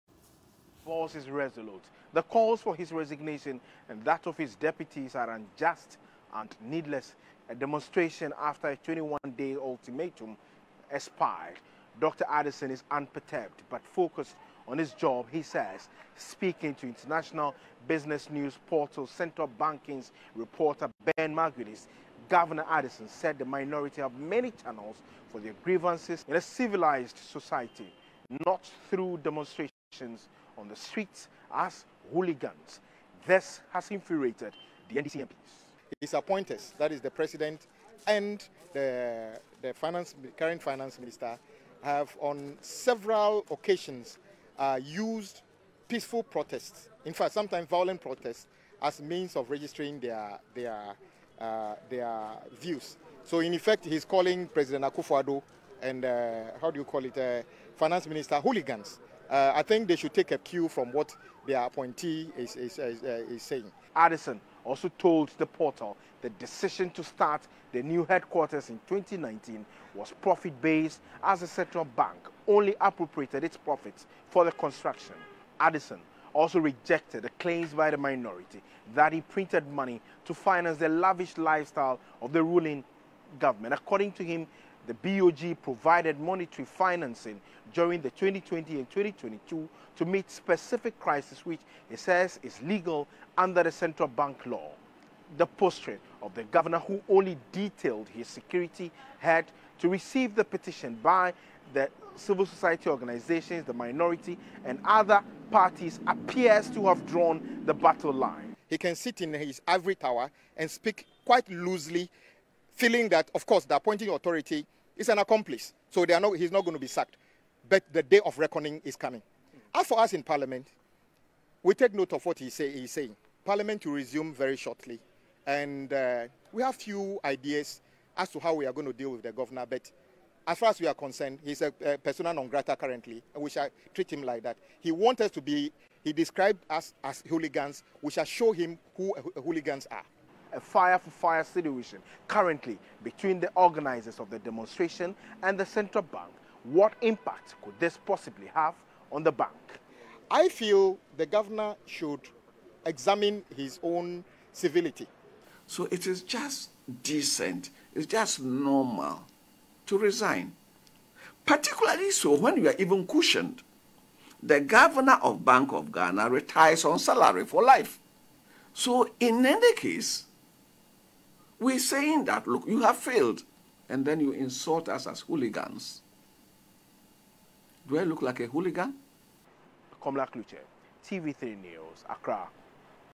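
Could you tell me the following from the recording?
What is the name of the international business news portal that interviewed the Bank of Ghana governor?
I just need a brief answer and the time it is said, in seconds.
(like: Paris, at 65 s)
Central Banking, at 19 s.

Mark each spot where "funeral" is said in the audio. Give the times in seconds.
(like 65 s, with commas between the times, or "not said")
not said.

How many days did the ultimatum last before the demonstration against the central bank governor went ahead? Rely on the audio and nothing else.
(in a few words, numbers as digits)
21.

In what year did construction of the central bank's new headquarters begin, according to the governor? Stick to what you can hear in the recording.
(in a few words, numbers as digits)
2019.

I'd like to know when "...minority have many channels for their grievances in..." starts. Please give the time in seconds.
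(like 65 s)
23 s.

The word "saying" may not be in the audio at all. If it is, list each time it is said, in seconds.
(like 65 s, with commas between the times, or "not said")
63 s, 122 s, 171 s.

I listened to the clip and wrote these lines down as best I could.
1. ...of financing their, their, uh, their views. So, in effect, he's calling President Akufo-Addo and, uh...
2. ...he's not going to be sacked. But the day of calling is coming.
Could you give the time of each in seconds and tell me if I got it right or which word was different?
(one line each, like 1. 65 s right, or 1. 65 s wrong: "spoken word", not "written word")
1. 49 s wrong: "registering", not "financing"
2. 116 s wrong: "reckoning", not "calling".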